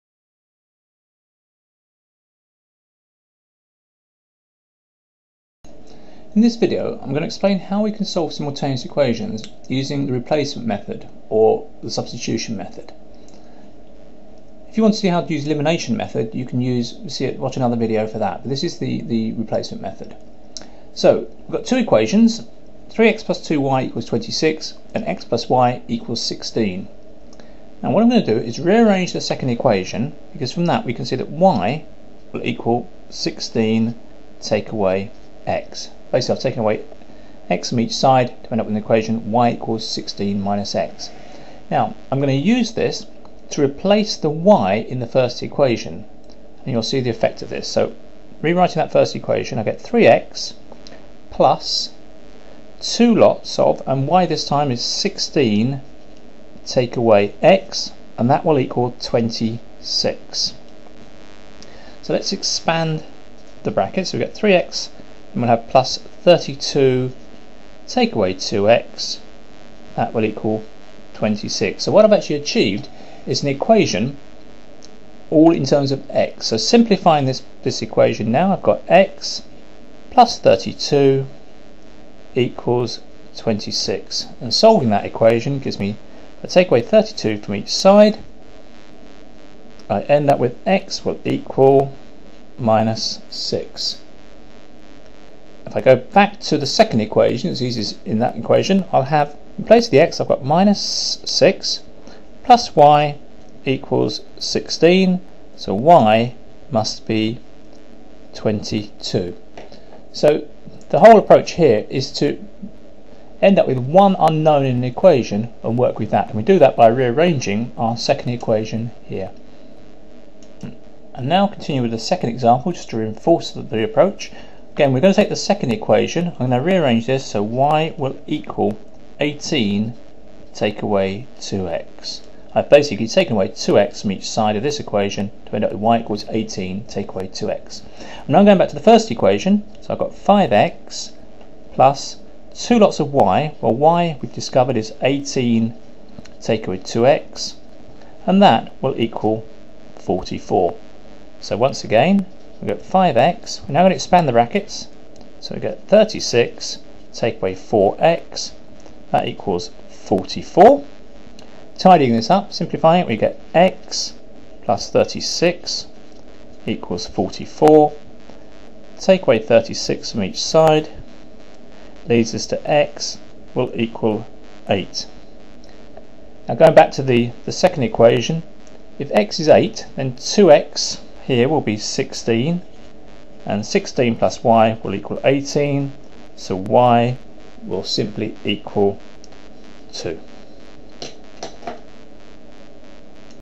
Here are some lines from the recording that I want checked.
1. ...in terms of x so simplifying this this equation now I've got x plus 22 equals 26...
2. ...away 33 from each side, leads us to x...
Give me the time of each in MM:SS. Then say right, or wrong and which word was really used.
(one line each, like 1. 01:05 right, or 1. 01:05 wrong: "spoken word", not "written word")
1. 01:15 wrong: "32", not "22"
2. 02:49 wrong: "36", not "33".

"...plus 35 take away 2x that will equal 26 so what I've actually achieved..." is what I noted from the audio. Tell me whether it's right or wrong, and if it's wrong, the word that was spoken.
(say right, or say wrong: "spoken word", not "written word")
wrong: "32", not "35".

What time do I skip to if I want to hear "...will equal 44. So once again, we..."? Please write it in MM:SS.
02:28.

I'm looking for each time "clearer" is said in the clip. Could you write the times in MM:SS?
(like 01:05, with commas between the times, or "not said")
not said.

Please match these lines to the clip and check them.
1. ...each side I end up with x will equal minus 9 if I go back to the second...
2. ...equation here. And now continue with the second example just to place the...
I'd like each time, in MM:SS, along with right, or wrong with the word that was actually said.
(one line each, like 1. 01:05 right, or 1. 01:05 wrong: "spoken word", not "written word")
1. 01:27 wrong: "6", not "9"
2. 01:58 wrong: "reinforce", not "place".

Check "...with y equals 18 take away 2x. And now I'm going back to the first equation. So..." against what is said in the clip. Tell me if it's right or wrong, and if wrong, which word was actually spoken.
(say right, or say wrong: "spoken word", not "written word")
right.